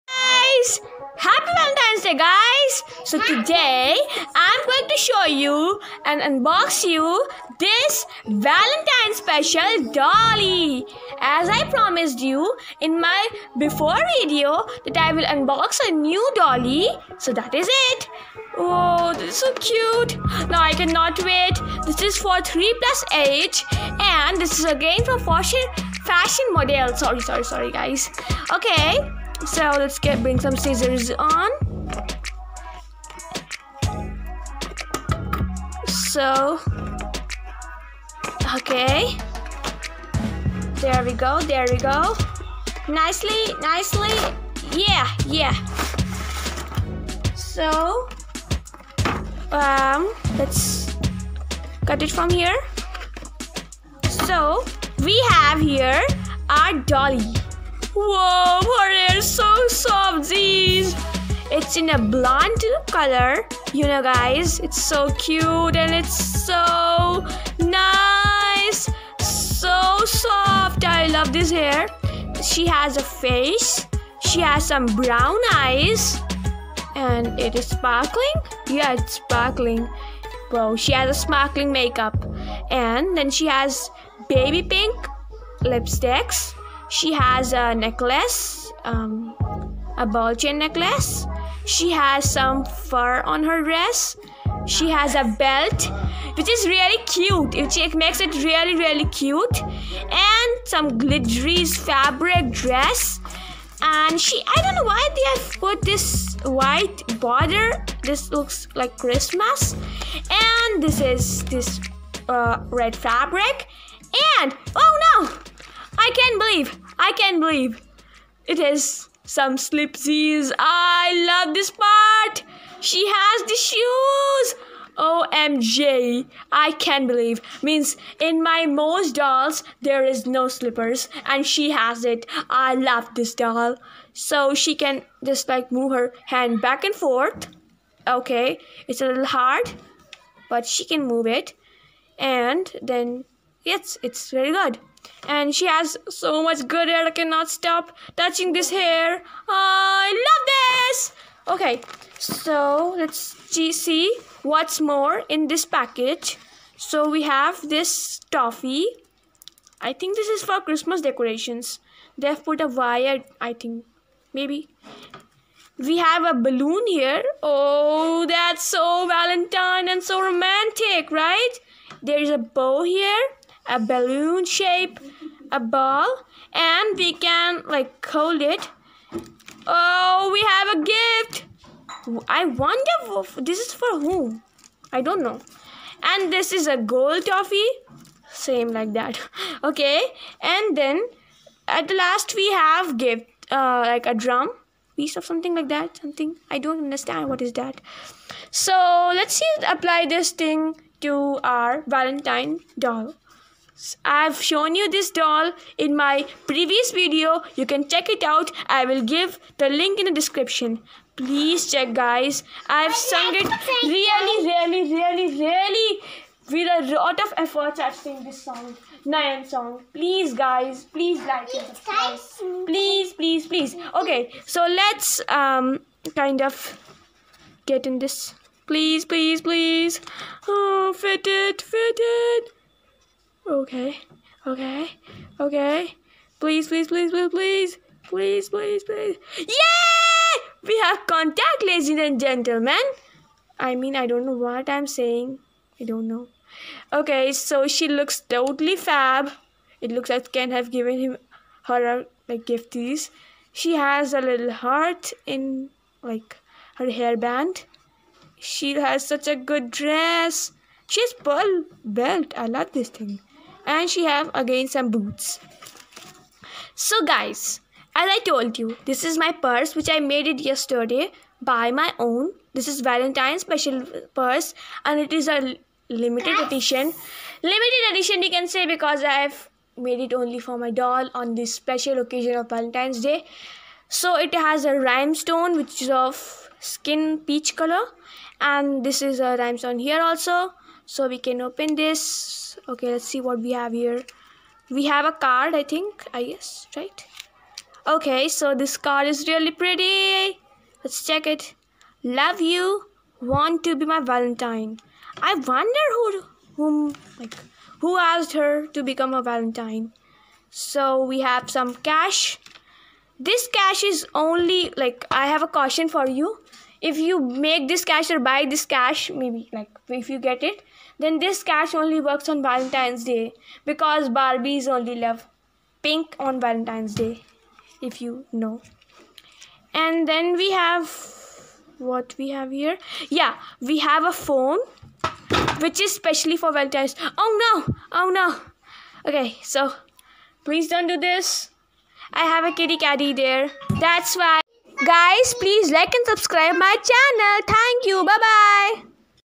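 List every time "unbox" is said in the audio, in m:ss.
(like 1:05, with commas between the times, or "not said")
0:06, 0:15.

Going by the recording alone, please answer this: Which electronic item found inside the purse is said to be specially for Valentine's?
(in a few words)
A phone.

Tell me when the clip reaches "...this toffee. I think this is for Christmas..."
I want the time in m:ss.
2:37.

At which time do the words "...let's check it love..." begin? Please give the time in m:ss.
5:00.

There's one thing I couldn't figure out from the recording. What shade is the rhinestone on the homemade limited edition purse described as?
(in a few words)
Skin peach.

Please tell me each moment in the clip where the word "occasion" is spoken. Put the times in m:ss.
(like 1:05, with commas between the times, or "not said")
4:41.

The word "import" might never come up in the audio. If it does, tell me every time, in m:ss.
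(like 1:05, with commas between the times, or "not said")
not said.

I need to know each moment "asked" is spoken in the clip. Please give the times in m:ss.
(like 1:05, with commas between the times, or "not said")
5:08.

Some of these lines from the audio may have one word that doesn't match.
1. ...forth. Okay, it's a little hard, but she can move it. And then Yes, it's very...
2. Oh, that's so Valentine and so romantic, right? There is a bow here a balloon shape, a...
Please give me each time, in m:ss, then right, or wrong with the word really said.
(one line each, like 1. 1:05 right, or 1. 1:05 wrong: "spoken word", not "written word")
1. 2:16 right
2. 2:47 right.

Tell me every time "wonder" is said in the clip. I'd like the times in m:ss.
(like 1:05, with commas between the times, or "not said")
3:02, 5:05.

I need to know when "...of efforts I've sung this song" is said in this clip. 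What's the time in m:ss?
3:37.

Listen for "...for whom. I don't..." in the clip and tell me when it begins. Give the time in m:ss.
3:03.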